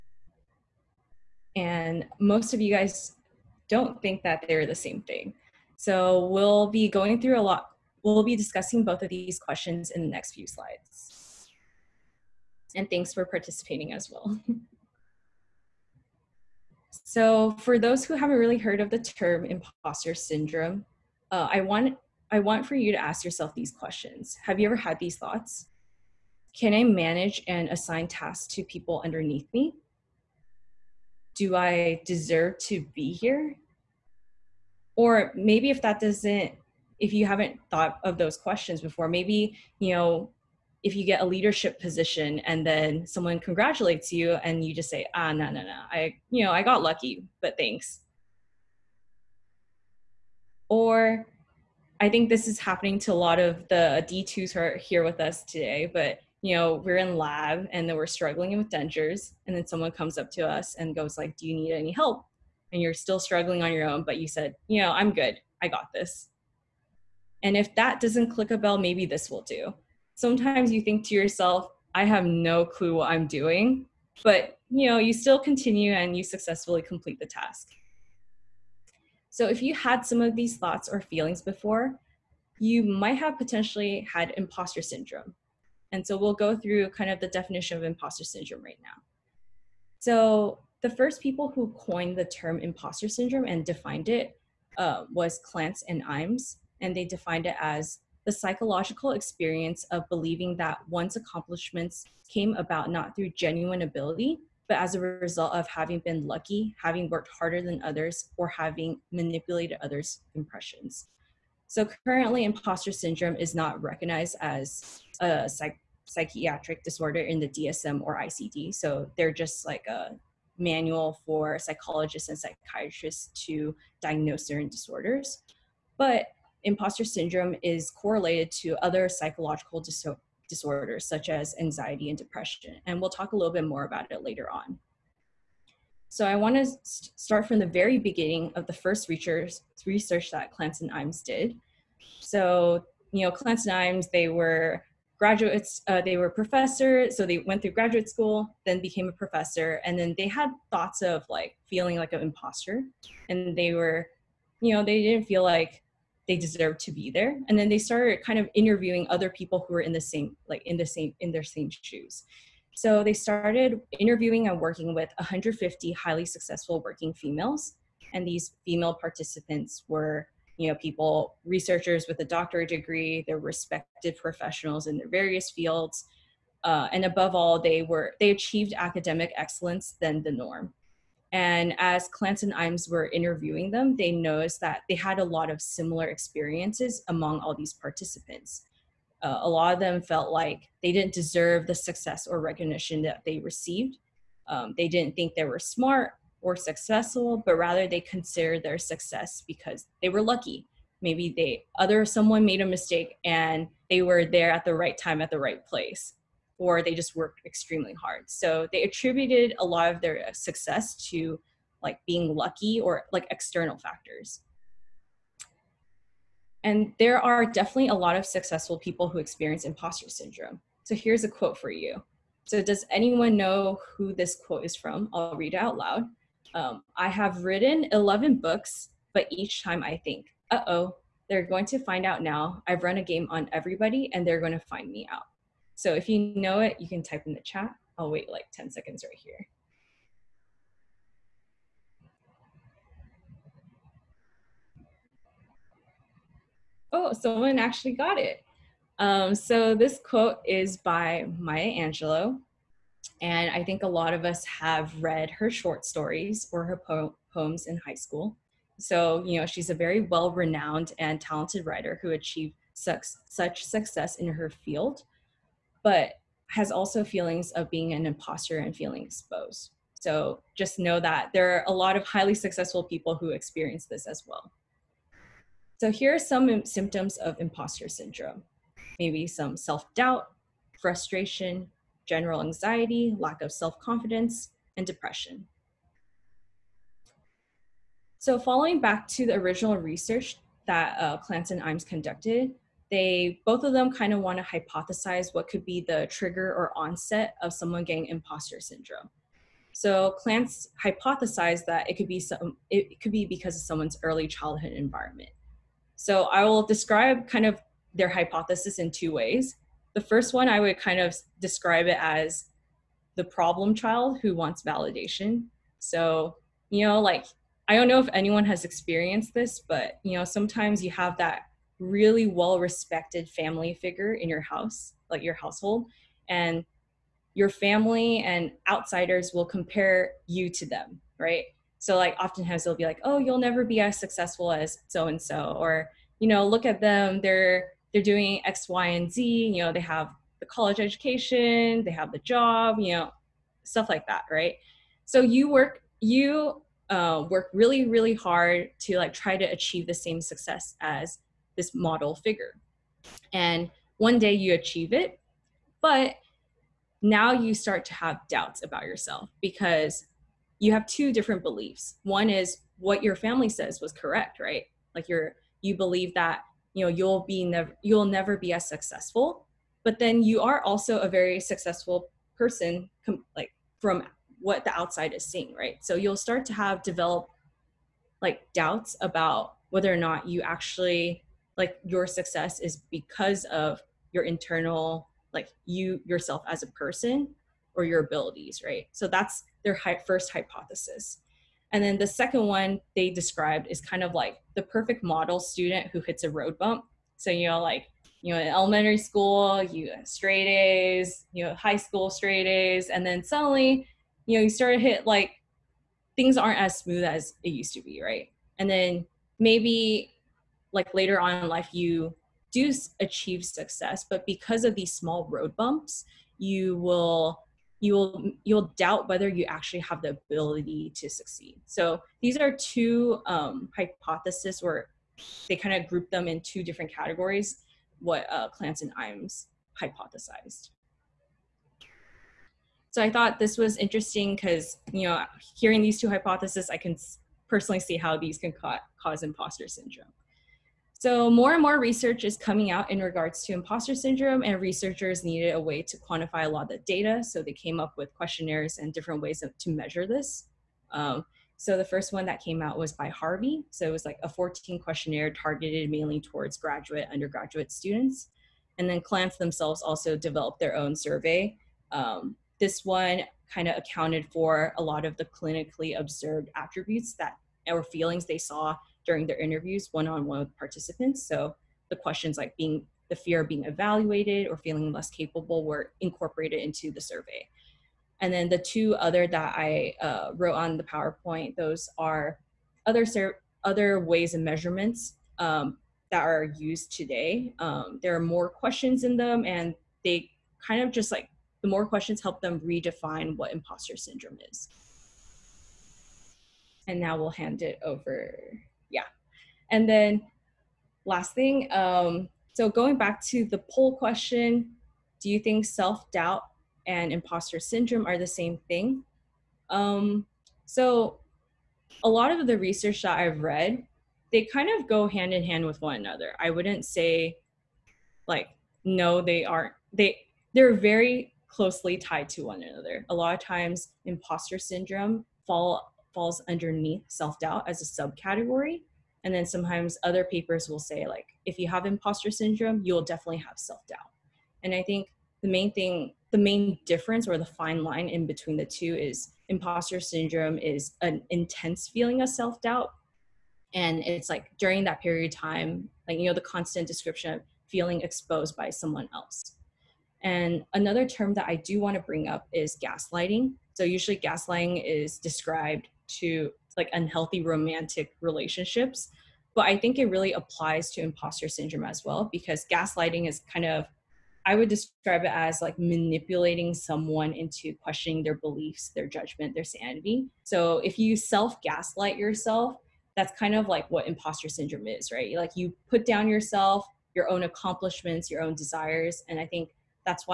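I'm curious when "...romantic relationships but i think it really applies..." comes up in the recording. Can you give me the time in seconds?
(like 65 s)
557 s.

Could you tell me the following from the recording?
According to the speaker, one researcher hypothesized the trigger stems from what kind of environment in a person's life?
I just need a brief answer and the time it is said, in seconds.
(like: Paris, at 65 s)
Early childhood environment, at 304 s.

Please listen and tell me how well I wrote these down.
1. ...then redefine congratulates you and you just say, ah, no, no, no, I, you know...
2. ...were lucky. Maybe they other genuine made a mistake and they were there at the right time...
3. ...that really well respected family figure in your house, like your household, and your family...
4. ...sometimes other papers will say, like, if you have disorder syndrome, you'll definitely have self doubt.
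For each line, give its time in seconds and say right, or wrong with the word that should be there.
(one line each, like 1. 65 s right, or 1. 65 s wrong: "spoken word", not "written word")
1. 42 s wrong: "someone", not "redefine"
2. 200 s wrong: "someone", not "genuine"
3. 321 s right
4. 529 s wrong: "imposter", not "disorder".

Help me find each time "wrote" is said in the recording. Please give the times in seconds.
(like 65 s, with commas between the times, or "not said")
480 s.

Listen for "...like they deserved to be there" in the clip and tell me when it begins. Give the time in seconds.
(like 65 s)
155 s.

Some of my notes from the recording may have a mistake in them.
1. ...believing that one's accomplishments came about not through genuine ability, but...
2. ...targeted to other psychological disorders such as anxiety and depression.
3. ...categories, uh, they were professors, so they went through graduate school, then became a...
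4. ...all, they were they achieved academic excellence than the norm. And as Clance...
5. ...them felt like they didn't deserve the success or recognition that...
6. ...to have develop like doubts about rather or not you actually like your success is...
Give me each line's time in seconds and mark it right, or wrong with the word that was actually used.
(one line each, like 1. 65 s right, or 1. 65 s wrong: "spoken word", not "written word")
1. 100 s right
2. 127 s wrong: "correlated", not "targeted"
3. 145 s wrong: "graduates", not "categories"
4. 177 s right
5. 189 s right
6. 376 s wrong: "whether", not "rather".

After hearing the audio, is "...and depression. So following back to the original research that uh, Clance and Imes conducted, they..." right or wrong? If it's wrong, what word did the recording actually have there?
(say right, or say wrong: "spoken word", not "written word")
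right.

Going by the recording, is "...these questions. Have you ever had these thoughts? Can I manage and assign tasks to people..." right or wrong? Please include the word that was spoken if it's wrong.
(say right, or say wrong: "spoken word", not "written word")
right.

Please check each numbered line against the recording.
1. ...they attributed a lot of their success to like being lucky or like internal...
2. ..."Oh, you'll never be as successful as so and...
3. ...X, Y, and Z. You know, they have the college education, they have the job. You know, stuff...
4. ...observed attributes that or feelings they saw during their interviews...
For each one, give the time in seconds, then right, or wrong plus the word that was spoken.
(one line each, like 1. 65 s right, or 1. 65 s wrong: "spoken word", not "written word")
1. 208 s wrong: "external", not "internal"
2. 333 s right
3. 338 s right
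4. 465 s right.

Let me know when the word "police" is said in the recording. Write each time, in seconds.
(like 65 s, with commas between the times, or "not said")
not said.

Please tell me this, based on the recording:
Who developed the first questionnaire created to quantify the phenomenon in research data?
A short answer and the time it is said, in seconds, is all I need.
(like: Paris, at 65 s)
Harvey, at 453 s.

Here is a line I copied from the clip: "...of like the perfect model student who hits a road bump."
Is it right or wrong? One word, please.
right.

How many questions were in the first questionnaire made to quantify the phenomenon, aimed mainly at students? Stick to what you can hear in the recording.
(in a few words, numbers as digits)
14.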